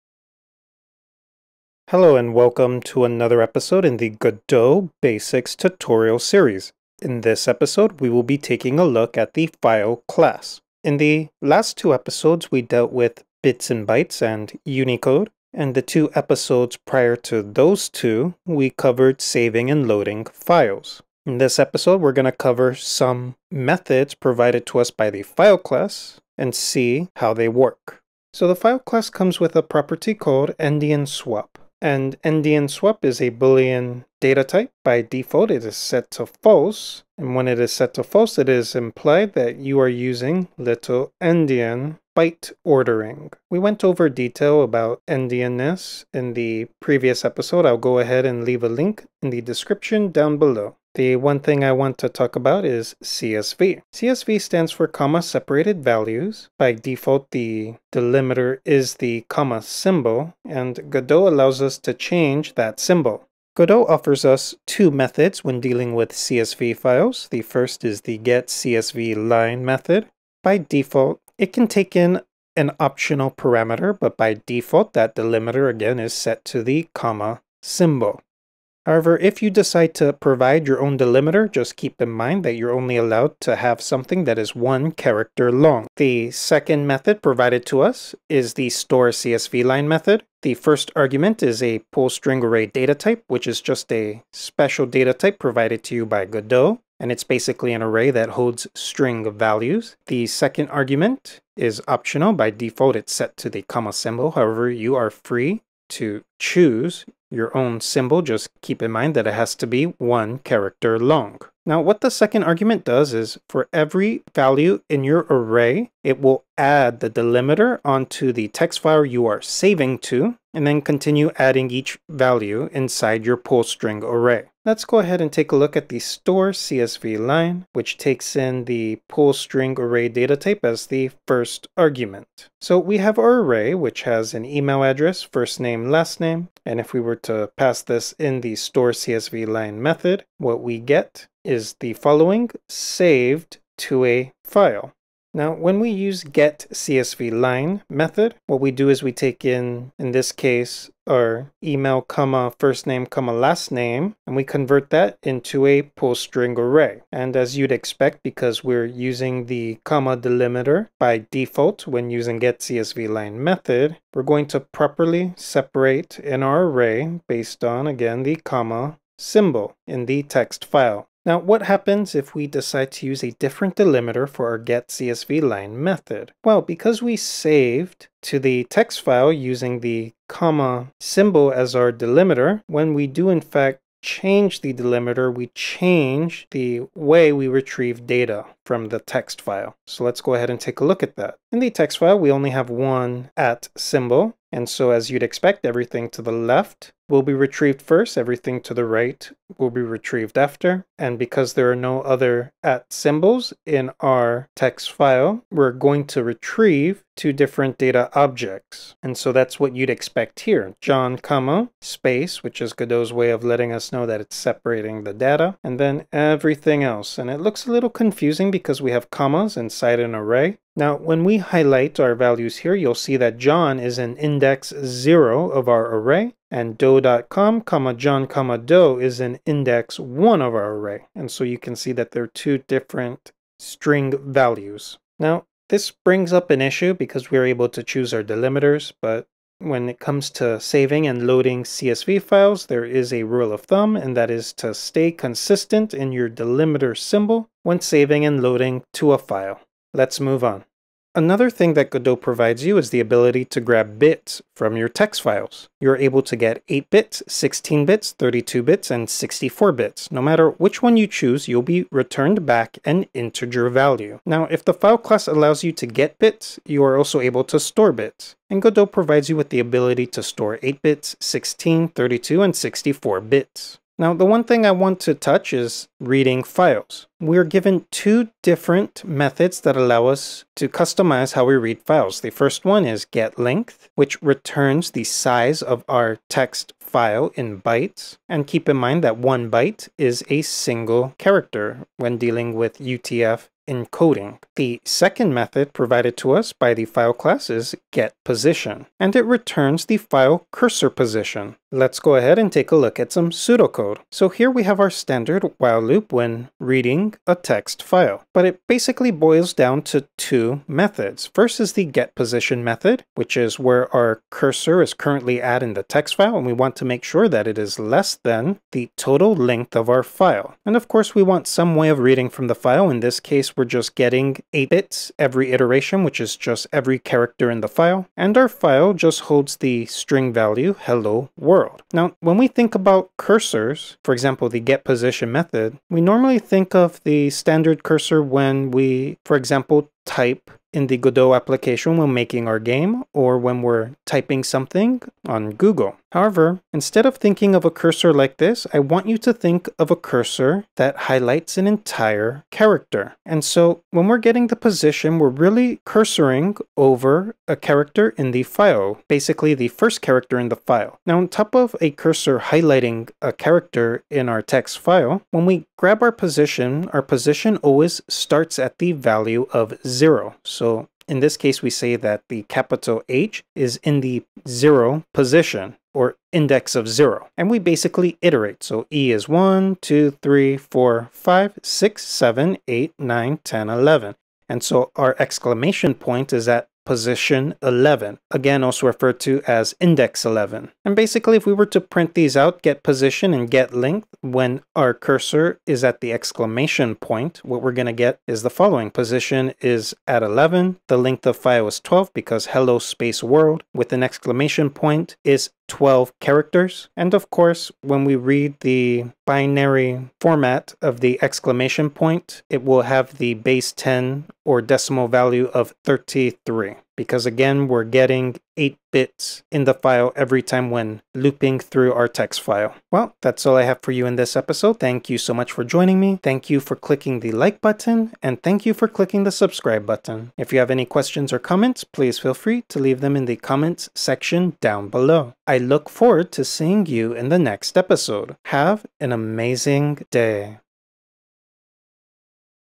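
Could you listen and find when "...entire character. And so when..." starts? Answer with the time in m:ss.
5:51.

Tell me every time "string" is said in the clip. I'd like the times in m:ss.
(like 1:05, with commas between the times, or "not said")
1:32, 1:38, 2:03, 2:09, 2:36, 3:53, 5:29.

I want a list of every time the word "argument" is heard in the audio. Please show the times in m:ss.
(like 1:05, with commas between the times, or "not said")
1:30, 1:40, 1:52, 2:11.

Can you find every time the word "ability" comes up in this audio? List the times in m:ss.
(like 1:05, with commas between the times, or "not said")
4:13, 4:29.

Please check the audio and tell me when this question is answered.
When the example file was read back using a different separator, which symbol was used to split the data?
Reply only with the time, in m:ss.
3:13.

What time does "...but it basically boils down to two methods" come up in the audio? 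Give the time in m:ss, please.
5:08.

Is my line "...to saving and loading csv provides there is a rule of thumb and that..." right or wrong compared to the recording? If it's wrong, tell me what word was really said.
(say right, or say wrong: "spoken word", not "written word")
wrong: "files", not "provides".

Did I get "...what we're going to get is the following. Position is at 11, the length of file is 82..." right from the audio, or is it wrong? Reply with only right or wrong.
wrong.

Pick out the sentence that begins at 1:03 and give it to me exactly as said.
Godot offers us two methods when dealing with CSV files.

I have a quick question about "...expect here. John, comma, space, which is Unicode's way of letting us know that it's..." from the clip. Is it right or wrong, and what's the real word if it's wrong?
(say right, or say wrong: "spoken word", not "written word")
wrong: "Godot", not "Unicode".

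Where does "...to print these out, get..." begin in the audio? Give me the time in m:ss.
6:31.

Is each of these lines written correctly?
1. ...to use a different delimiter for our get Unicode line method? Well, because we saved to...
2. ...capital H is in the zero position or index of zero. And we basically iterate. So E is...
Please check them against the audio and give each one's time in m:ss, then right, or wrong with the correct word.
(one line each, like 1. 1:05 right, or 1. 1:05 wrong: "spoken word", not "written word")
1. 2:52 wrong: "CSV", not "Unicode"
2. 6:12 right.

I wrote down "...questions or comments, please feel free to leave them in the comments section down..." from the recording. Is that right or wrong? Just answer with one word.
right.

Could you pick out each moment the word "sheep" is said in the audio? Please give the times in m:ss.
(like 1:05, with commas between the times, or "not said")
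not said.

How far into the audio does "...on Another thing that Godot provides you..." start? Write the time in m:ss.
4:10.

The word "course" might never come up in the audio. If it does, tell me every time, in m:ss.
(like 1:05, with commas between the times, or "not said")
5:20, 6:47.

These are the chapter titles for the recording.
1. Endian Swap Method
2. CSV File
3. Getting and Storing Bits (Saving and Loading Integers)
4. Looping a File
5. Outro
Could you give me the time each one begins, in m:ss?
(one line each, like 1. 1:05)
1. 0:28
2. 0:51
3. 4:11
4. 4:34
5. 7:03.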